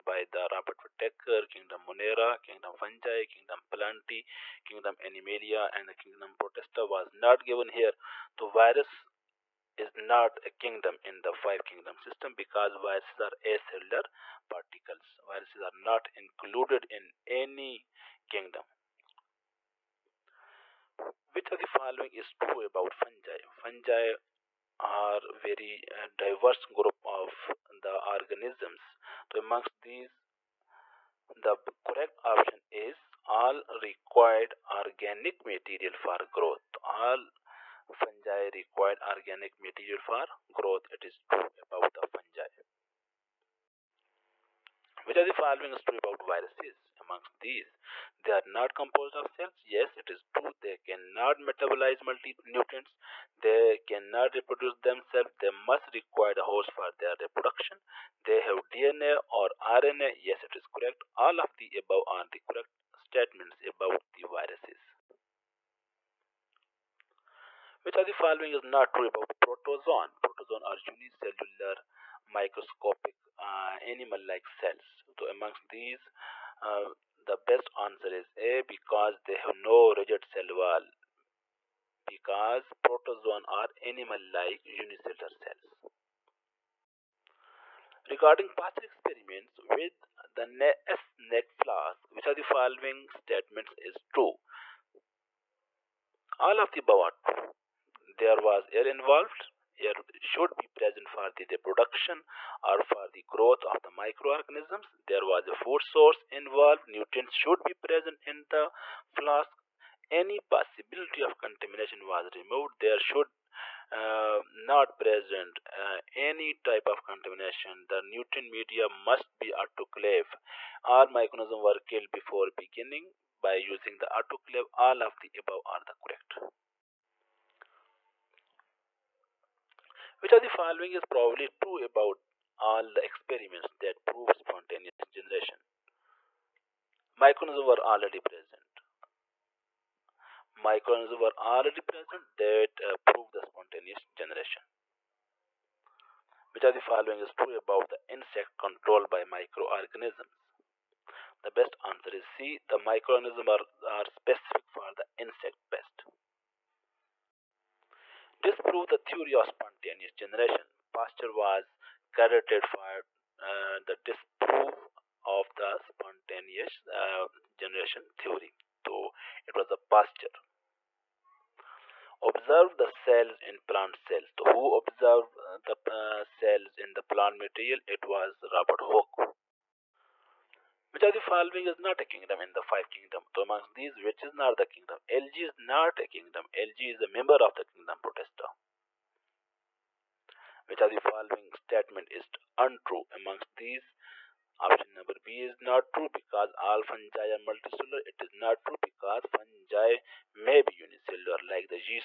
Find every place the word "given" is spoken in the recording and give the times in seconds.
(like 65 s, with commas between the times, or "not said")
7 s.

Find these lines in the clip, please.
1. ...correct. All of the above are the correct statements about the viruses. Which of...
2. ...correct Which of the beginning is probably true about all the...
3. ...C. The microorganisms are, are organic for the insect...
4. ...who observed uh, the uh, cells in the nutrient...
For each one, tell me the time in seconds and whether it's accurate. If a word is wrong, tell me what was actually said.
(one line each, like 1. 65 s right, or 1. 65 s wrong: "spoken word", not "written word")
1. 60 s right
2. 126 s wrong: "following", not "beginning"
3. 152 s wrong: "specific", not "organic"
4. 174 s wrong: "plant", not "nutrient".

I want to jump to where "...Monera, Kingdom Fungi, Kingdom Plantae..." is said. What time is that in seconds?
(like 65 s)
1 s.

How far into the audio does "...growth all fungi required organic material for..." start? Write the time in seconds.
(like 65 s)
36 s.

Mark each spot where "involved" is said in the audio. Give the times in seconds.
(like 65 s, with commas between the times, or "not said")
98 s, 106 s.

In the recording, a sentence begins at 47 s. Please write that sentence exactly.
Amongst these, they are not composed of cells.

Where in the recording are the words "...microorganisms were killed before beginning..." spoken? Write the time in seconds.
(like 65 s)
121 s.